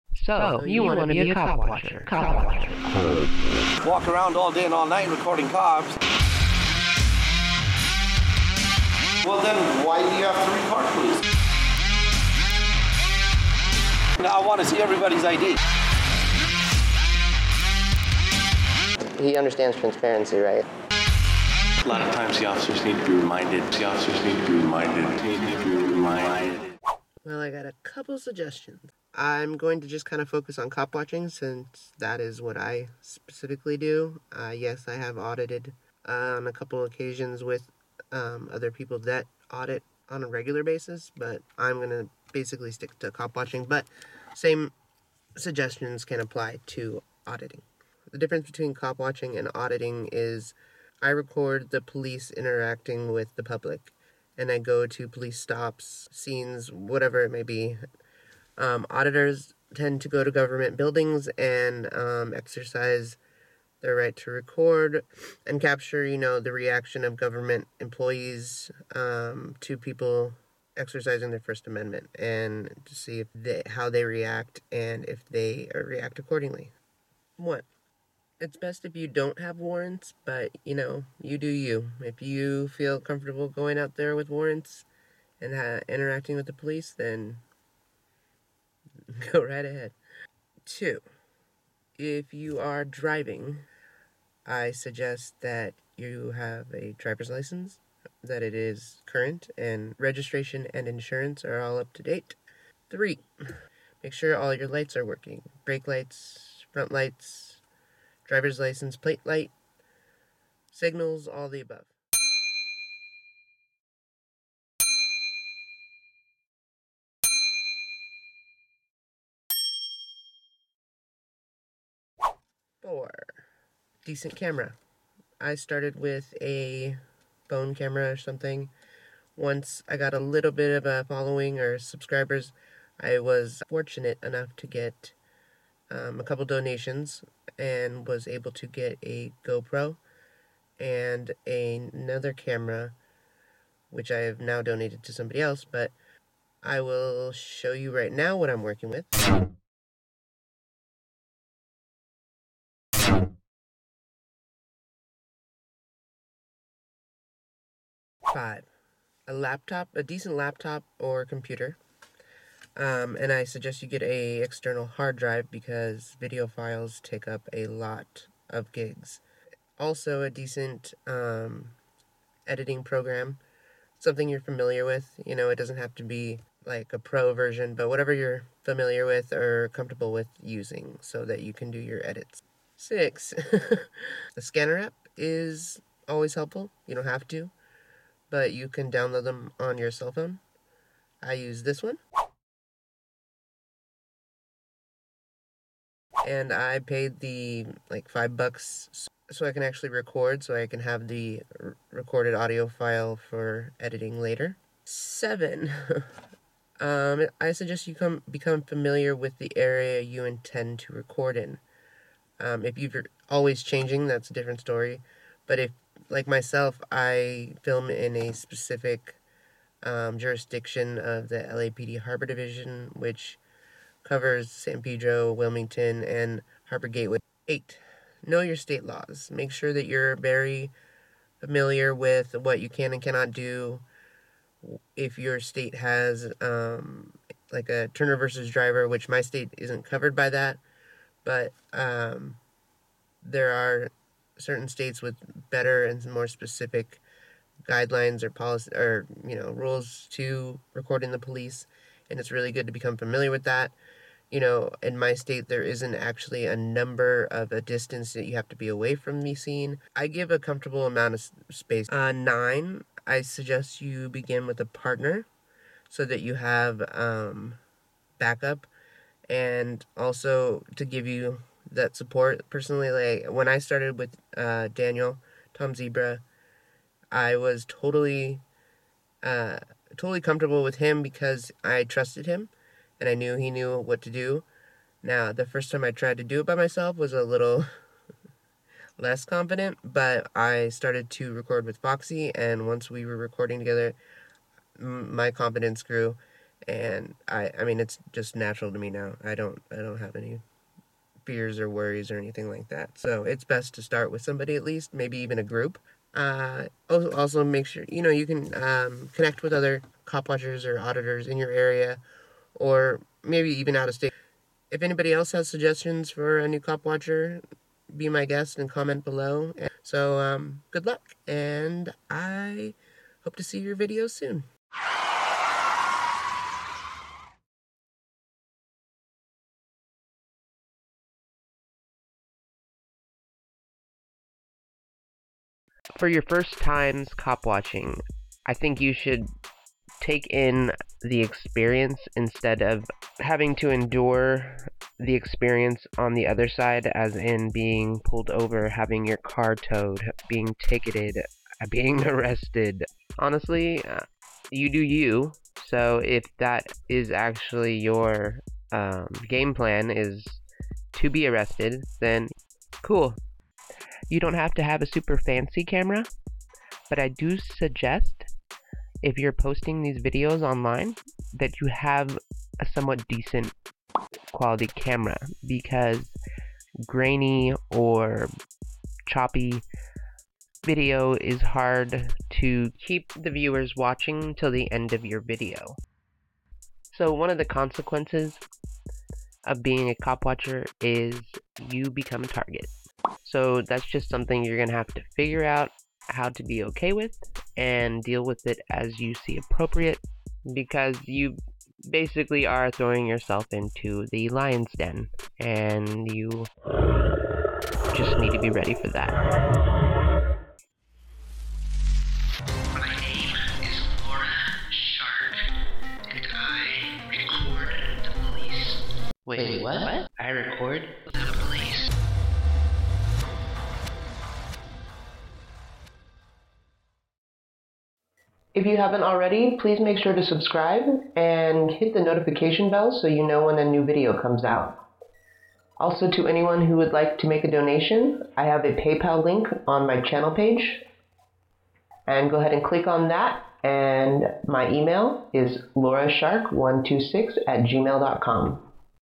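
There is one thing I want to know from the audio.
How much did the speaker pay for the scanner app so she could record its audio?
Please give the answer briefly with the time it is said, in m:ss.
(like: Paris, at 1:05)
5 dollars, at 3:18.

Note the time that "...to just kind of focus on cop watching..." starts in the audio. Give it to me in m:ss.
0:29.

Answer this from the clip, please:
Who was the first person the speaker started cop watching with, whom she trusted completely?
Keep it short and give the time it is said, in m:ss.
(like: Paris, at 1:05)
Daniel Tom Zebra, at 4:34.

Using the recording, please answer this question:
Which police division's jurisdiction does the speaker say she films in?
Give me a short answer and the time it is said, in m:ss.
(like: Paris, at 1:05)
LAPD Harbor Division, at 3:41.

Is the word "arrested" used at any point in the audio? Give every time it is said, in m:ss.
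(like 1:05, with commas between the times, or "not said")
5:52, 6:01.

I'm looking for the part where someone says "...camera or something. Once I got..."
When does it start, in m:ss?
2:07.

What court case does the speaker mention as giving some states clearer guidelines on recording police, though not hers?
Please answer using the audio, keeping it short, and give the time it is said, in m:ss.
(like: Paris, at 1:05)
Turner versus Driver, at 3:57.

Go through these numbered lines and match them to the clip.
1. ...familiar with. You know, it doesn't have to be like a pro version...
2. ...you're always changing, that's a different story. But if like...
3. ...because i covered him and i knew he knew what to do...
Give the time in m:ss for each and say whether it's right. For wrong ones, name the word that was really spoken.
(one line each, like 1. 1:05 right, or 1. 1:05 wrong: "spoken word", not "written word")
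1. 2:54 right
2. 3:32 right
3. 4:41 wrong: "trusted", not "covered".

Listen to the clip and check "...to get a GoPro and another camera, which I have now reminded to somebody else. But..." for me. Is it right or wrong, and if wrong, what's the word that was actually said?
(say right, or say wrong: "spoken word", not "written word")
wrong: "donated", not "reminded".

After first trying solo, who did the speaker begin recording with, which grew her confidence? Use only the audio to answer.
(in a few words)
Foxy.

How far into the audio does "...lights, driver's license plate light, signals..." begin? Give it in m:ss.
1:46.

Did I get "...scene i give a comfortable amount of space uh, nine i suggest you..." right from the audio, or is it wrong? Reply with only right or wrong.
right.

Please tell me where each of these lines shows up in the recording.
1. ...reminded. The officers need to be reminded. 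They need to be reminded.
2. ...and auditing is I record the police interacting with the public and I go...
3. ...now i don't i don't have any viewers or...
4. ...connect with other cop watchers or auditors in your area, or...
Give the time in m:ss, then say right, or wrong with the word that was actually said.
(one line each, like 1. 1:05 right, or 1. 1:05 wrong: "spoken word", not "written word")
1. 0:23 right
2. 0:49 right
3. 4:58 wrong: "fears", not "viewers"
4. 5:09 right.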